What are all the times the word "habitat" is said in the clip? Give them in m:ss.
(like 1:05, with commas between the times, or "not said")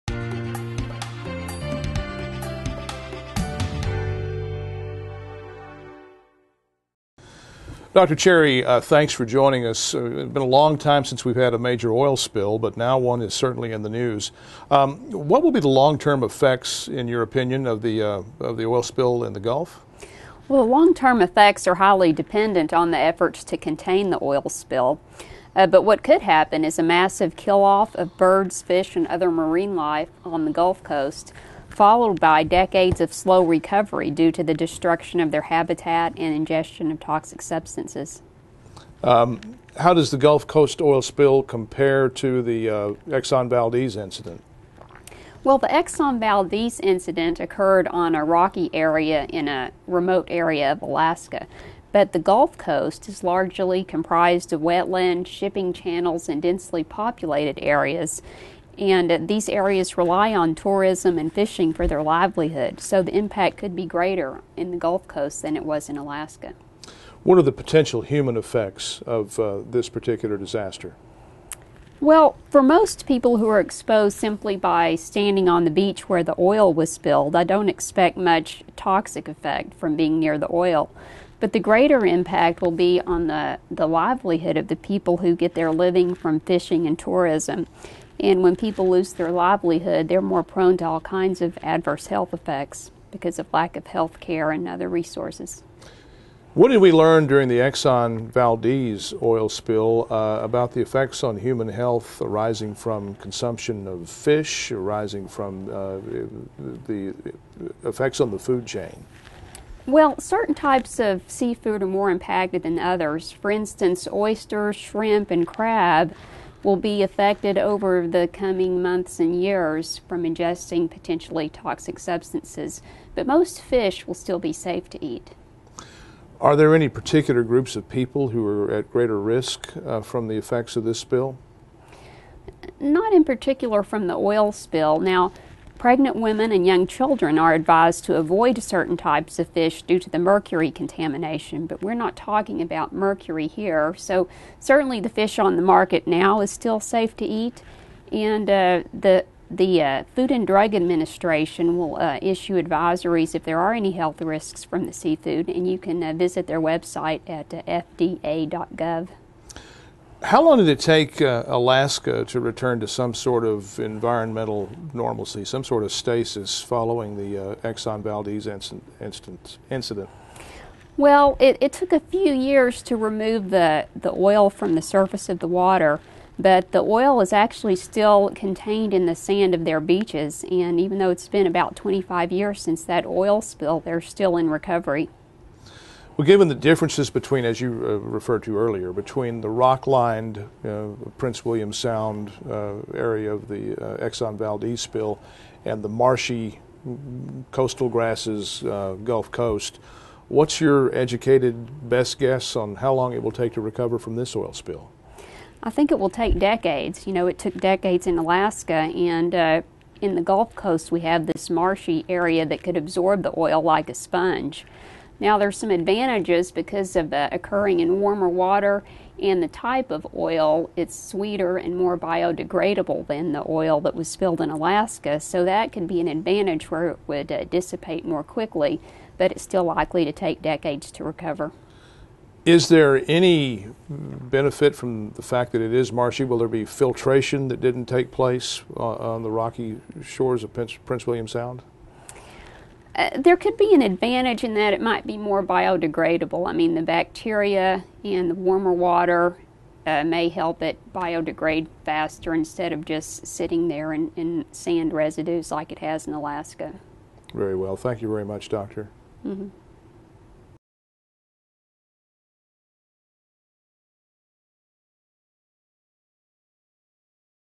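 0:35.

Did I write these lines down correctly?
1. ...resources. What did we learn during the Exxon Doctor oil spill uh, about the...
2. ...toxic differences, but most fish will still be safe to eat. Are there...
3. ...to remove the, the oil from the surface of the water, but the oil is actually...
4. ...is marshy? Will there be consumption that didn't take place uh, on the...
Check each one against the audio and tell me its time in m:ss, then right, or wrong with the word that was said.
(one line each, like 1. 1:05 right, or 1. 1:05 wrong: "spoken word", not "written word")
1. 1:34 wrong: "Valdez", not "Doctor"
2. 2:01 wrong: "substances", not "differences"
3. 2:52 right
4. 3:55 wrong: "filtration", not "consumption".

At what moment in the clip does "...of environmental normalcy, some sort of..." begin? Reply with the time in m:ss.
2:43.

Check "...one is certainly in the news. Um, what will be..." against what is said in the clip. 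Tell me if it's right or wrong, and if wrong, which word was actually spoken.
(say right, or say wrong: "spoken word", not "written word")
right.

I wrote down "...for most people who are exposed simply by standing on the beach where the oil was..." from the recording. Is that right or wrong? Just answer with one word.
right.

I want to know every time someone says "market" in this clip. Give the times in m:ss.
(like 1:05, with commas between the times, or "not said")
2:25.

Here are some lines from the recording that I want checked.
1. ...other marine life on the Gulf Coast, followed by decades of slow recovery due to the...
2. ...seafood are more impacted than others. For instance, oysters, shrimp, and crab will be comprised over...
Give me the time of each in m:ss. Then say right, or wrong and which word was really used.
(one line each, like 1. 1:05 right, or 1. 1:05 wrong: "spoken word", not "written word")
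1. 0:29 right
2. 1:51 wrong: "affected", not "comprised".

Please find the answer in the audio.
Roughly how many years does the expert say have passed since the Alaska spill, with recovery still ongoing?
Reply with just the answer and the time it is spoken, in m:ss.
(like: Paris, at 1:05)
25, at 3:01.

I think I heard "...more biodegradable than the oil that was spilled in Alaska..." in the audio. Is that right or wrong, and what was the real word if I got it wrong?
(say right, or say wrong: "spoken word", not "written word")
right.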